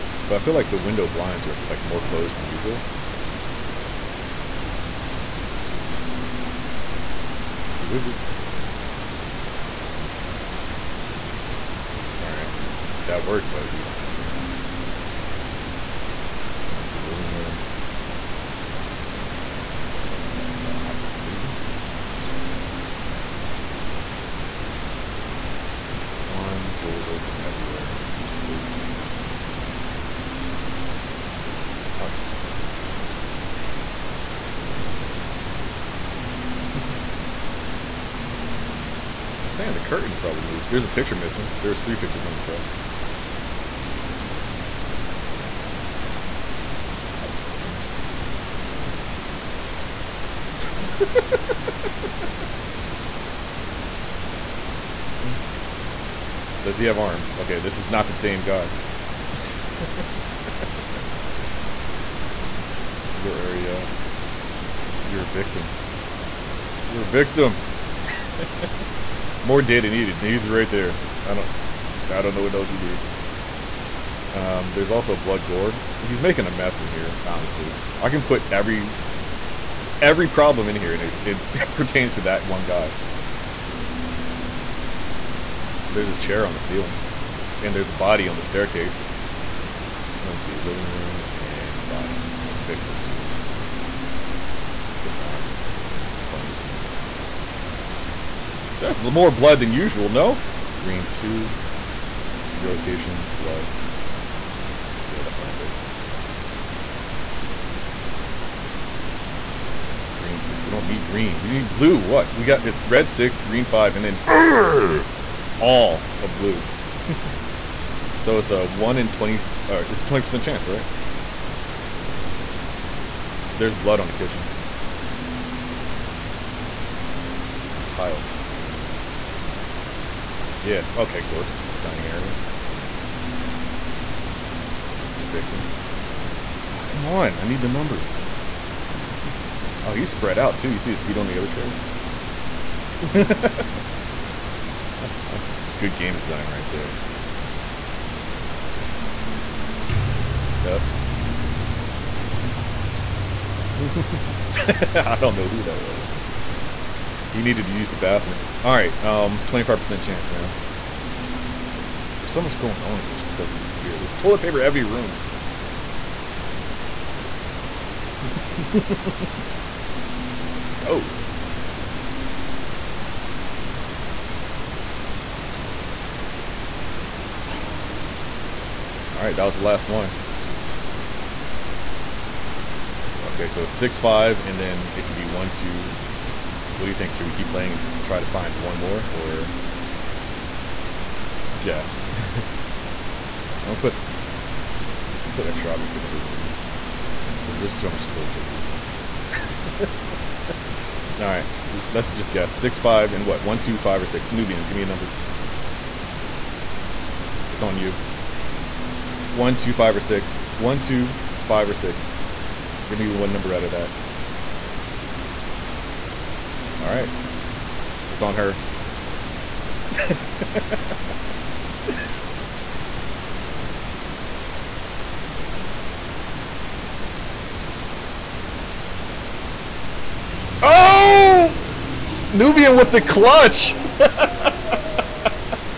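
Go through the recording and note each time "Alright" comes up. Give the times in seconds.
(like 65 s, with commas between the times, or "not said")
12 s, 179 s, 201 s.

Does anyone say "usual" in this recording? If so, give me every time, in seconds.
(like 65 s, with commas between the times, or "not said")
2 s, 99 s.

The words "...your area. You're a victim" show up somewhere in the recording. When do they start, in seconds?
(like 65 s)
63 s.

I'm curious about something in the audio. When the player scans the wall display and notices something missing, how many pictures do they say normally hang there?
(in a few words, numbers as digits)
3.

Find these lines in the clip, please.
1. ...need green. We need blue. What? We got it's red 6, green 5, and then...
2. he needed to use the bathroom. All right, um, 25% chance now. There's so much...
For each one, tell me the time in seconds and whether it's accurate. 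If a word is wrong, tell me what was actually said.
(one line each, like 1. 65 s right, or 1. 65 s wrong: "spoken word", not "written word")
1. 110 s right
2. 157 s right.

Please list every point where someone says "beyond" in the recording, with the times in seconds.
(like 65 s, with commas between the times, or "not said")
not said.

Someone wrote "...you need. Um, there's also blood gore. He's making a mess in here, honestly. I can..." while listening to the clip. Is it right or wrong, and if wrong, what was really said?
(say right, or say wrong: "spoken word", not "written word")
right.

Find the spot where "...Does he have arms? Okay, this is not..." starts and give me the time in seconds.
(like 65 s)
56 s.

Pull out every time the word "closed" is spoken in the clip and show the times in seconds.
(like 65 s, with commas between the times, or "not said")
2 s.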